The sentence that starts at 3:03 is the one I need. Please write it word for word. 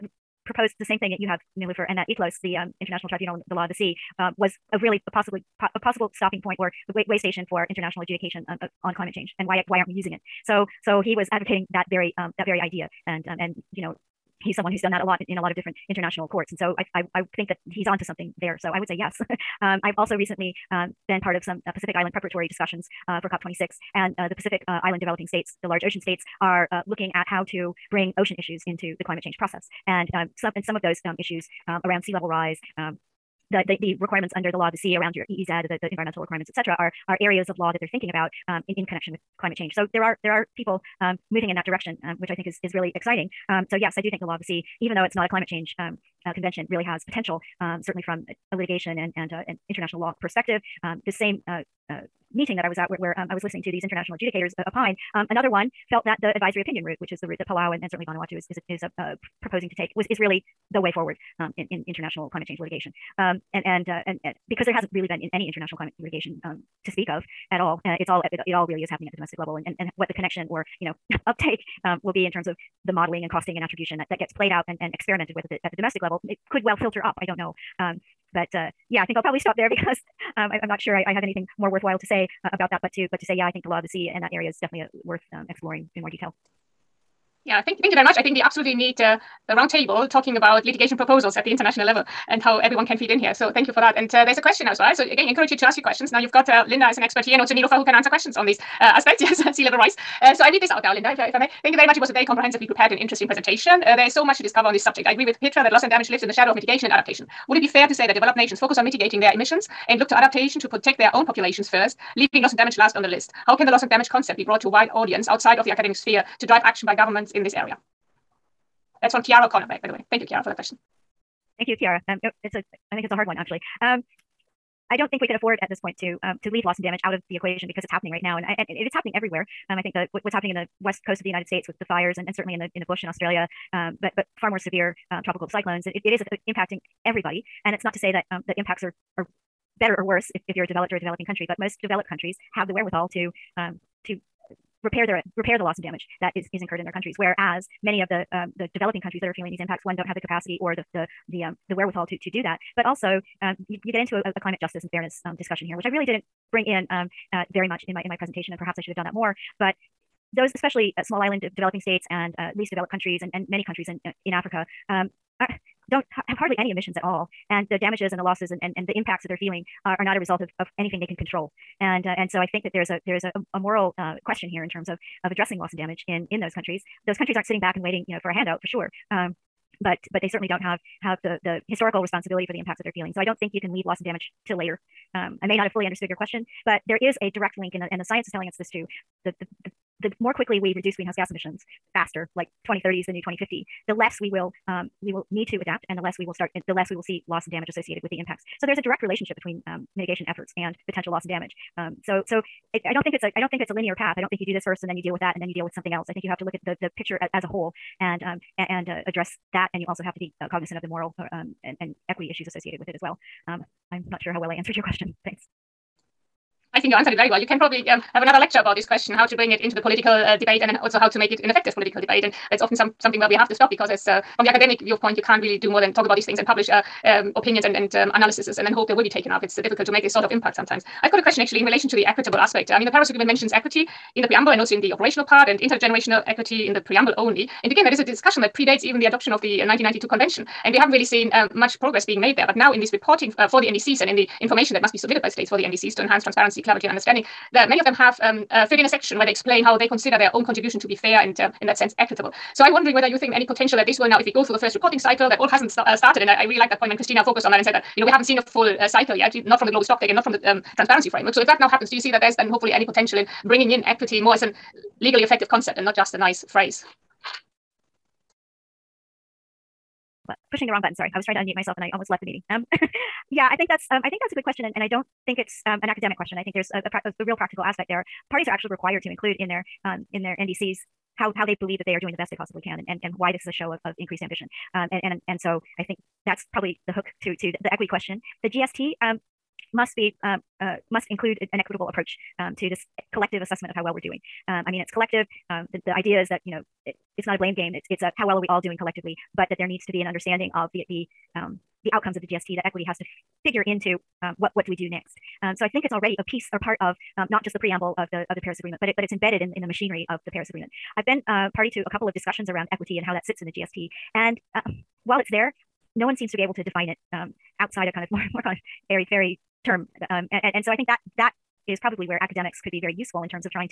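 So I don't think you can leave loss and damage till later.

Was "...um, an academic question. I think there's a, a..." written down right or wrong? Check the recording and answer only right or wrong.
right.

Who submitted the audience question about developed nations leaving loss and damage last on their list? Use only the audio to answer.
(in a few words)
Kiara O'Connor.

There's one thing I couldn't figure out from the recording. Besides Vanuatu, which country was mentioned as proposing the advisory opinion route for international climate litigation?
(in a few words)
Palau.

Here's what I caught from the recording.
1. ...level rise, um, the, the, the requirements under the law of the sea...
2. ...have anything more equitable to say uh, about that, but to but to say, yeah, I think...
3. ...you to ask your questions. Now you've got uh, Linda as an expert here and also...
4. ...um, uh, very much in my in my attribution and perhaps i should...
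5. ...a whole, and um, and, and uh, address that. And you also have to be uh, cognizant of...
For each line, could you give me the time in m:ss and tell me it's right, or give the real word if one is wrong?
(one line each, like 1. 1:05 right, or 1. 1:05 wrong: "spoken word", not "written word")
1. 0:32 right
2. 1:21 wrong: "worthwhile", not "equitable"
3. 1:35 right
4. 2:36 wrong: "presentation", not "attribution"
5. 3:27 right.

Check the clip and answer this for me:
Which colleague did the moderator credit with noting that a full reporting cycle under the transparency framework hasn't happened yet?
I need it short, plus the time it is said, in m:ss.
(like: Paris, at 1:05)
Christina, at 4:16.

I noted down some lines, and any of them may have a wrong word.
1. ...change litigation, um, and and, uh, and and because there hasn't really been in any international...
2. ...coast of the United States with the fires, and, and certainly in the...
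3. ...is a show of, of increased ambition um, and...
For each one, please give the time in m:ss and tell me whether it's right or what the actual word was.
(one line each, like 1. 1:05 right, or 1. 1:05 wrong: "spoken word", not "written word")
1. 1:02 right
2. 2:11 right
3. 4:43 right.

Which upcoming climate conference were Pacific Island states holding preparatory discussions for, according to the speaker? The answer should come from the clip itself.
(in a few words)
COP26.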